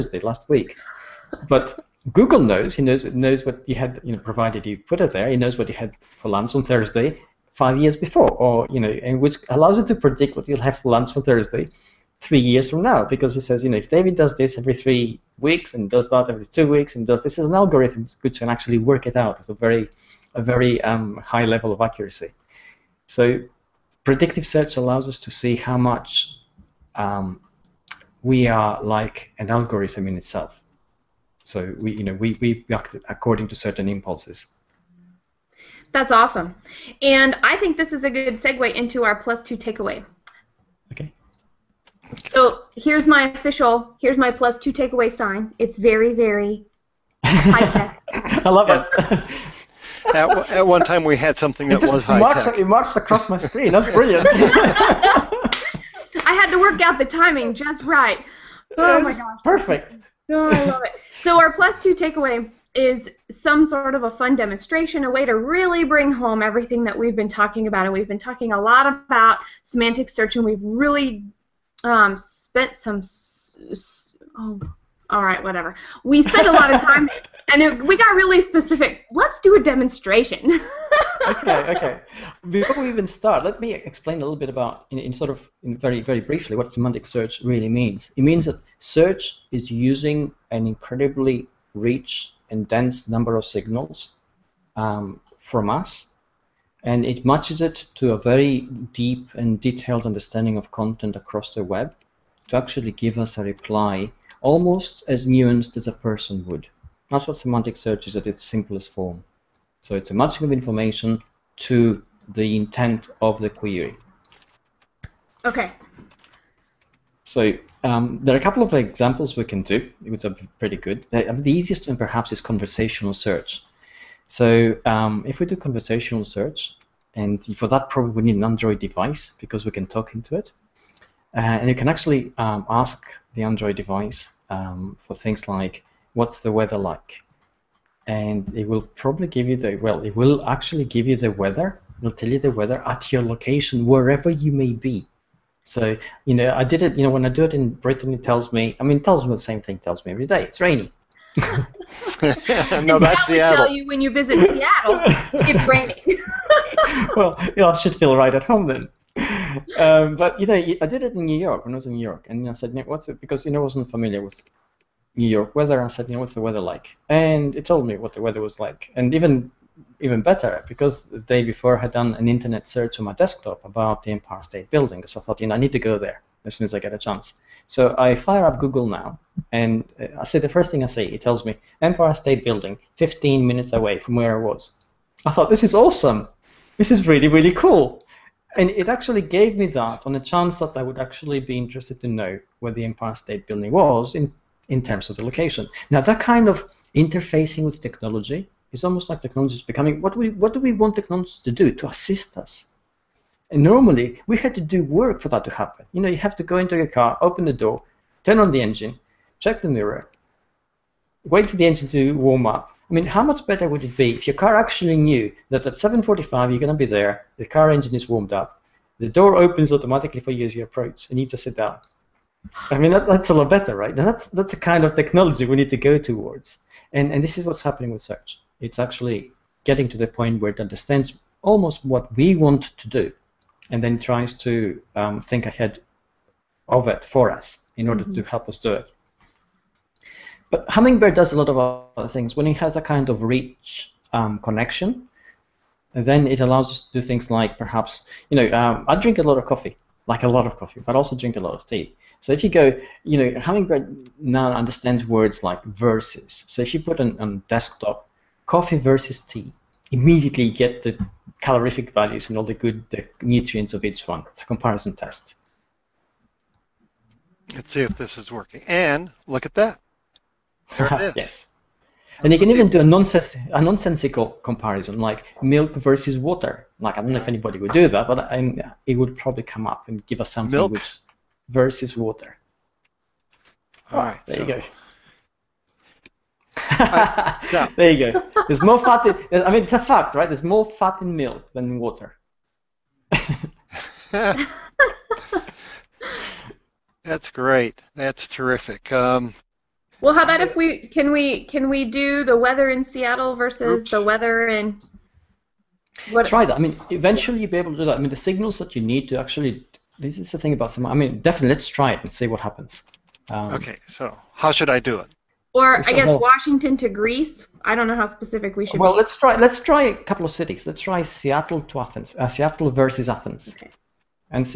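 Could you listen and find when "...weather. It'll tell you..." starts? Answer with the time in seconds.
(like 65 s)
141 s.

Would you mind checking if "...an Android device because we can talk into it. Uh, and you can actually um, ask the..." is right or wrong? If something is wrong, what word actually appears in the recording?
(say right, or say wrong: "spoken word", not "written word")
right.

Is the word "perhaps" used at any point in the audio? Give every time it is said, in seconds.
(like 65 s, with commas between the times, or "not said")
121 s, 247 s.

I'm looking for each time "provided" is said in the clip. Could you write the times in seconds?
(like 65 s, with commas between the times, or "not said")
4 s.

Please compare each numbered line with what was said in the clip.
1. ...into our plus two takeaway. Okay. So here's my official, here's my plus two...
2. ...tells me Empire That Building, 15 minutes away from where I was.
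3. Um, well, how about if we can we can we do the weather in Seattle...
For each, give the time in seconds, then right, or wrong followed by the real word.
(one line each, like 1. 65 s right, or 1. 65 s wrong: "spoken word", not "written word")
1. 38 s right
2. 181 s wrong: "State", not "That"
3. 298 s right.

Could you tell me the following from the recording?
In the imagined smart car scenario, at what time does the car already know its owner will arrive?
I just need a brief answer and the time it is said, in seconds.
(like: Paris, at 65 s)
7.45, at 215 s.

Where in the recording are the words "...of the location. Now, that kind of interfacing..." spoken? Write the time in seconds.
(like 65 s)
195 s.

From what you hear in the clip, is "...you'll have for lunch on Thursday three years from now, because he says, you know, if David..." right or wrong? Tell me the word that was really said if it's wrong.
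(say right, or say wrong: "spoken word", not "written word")
right.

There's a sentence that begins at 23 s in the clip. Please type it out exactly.
So, predictive search allows us to see how much um, we are like an algorithm in itself.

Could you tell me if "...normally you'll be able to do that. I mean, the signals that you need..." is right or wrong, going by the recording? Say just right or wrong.
wrong.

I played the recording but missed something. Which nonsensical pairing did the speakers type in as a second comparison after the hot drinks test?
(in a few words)
milk versus water.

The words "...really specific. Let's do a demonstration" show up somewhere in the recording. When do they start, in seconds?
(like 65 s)
78 s.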